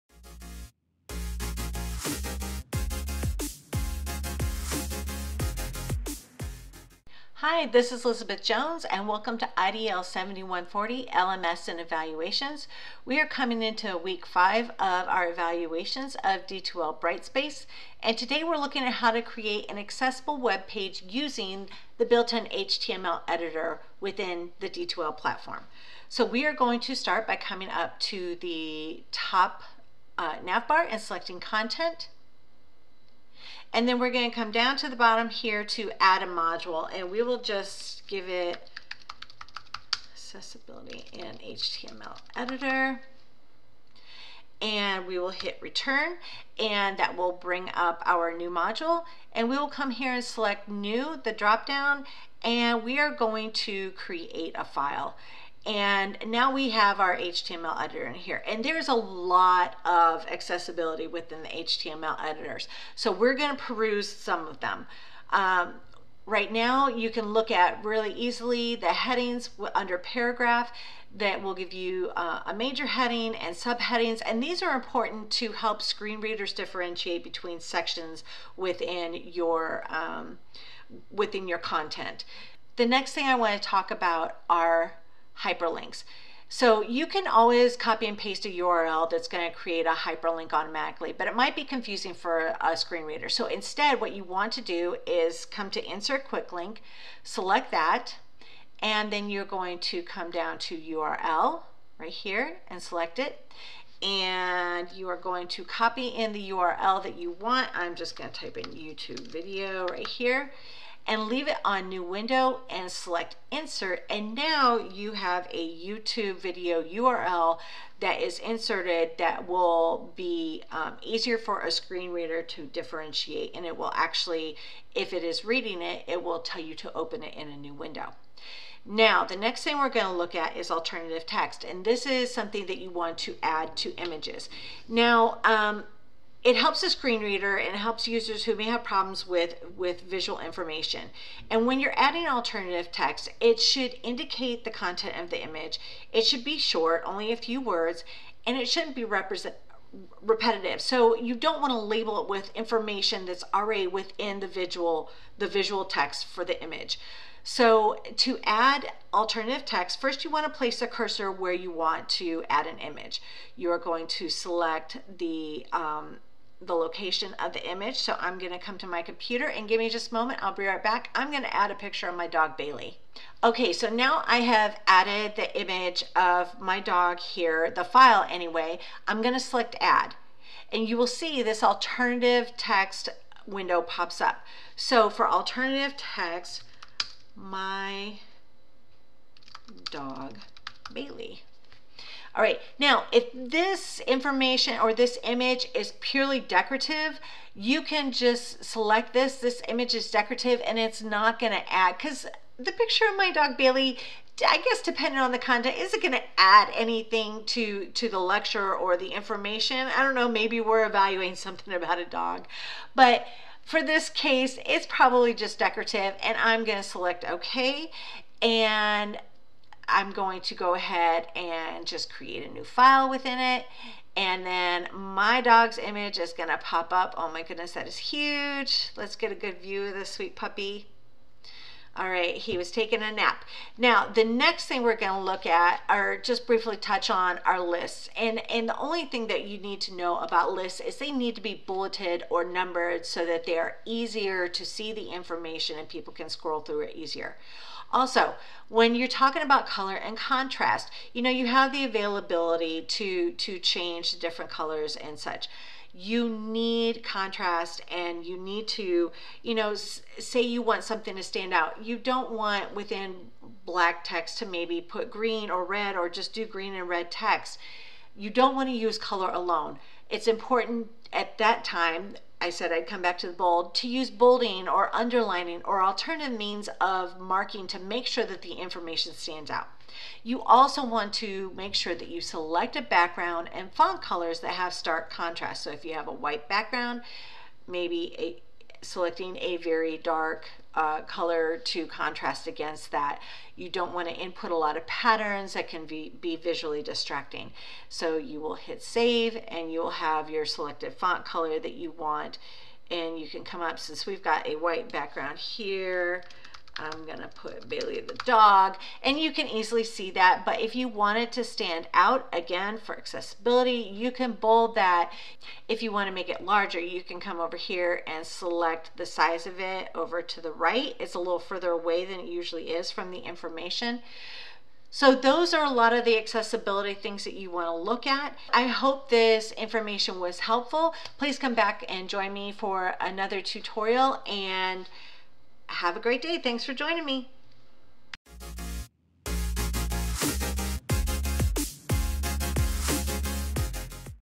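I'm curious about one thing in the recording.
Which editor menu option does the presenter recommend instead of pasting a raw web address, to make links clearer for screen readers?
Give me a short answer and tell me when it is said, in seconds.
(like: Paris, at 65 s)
Insert quick link, at 95 s.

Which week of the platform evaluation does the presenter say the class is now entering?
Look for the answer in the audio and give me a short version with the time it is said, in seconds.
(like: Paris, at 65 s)
Week five, at 13 s.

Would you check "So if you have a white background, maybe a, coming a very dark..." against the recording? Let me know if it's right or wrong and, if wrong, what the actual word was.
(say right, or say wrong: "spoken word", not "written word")
wrong: "selecting", not "coming".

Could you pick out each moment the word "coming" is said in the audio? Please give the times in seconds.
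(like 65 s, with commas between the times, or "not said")
13 s, 27 s.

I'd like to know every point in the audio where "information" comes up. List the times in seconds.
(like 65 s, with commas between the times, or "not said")
140 s, 152 s, 194 s, 209 s, 245 s, 278 s, 323 s, 329 s.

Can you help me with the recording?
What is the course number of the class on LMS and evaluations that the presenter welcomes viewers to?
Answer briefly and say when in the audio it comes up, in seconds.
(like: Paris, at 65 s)
IDL 7140, at 9 s.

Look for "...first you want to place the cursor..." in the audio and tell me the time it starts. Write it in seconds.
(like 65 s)
160 s.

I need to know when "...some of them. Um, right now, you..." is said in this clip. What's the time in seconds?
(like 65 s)
64 s.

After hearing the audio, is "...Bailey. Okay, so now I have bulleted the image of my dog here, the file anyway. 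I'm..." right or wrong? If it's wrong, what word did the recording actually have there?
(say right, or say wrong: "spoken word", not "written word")
wrong: "added", not "bulleted".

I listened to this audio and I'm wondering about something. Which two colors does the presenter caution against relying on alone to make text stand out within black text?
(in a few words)
Green and red.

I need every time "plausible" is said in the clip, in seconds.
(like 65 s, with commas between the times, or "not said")
not said.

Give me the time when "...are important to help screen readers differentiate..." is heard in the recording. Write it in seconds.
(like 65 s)
74 s.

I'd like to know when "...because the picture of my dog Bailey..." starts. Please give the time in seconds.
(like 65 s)
201 s.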